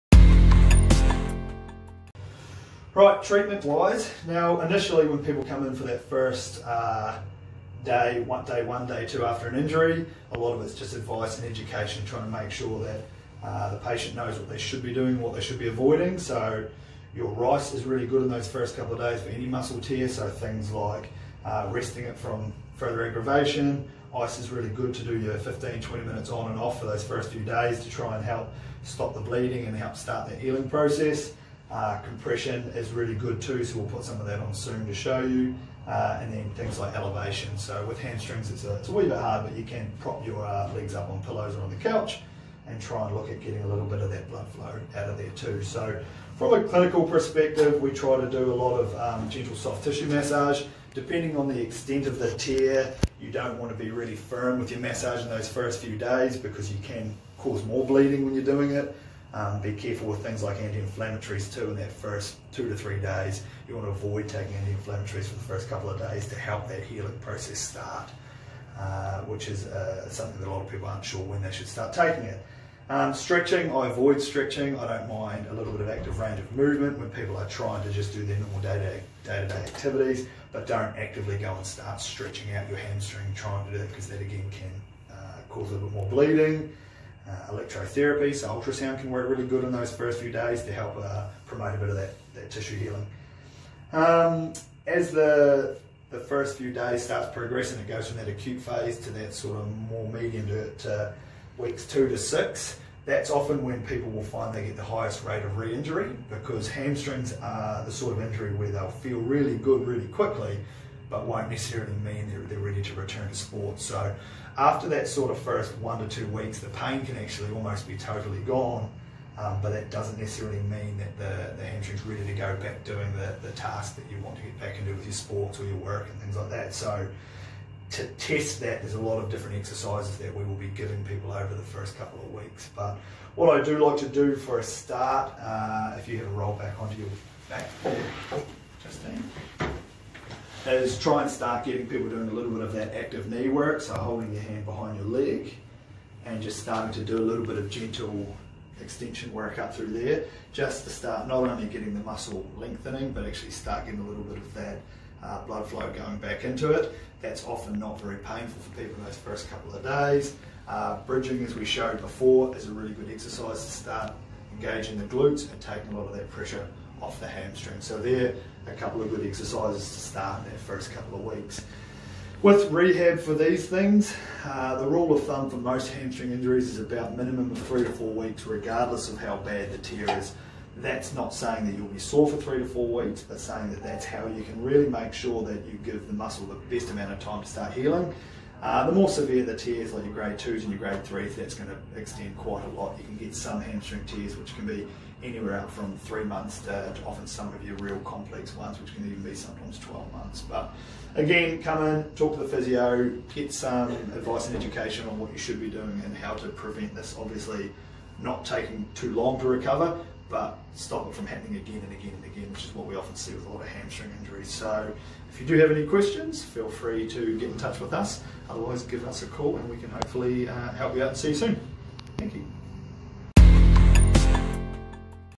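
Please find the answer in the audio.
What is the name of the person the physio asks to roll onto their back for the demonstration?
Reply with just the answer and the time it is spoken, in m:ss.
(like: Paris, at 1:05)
Justine, at 2:18.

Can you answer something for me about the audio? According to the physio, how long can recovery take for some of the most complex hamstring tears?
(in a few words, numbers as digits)
12 months.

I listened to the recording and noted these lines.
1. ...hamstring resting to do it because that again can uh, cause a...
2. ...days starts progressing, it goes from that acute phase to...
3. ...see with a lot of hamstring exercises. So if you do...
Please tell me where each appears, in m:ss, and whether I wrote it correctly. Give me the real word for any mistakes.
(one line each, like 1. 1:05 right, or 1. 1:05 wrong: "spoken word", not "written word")
1. 1:22 wrong: "trying", not "resting"
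2. 1:36 right
3. 3:33 wrong: "injuries", not "exercises".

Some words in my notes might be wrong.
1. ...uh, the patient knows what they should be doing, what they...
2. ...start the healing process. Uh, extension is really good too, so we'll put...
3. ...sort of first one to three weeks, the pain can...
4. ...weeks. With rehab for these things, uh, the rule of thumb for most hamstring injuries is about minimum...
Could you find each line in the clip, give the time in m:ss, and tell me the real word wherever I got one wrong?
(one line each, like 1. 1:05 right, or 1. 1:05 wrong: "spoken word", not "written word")
1. 0:13 right
2. 0:29 wrong: "compression", not "extension"
3. 1:55 wrong: "two", not "three"
4. 2:51 right.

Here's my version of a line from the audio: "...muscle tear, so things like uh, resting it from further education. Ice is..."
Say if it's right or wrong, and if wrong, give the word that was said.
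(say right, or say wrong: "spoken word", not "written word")
wrong: "aggravation", not "education".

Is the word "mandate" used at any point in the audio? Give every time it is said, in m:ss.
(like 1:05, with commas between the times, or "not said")
not said.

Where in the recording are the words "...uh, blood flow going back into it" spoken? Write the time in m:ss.
2:35.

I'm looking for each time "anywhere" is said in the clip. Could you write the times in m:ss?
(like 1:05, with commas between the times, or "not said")
3:15.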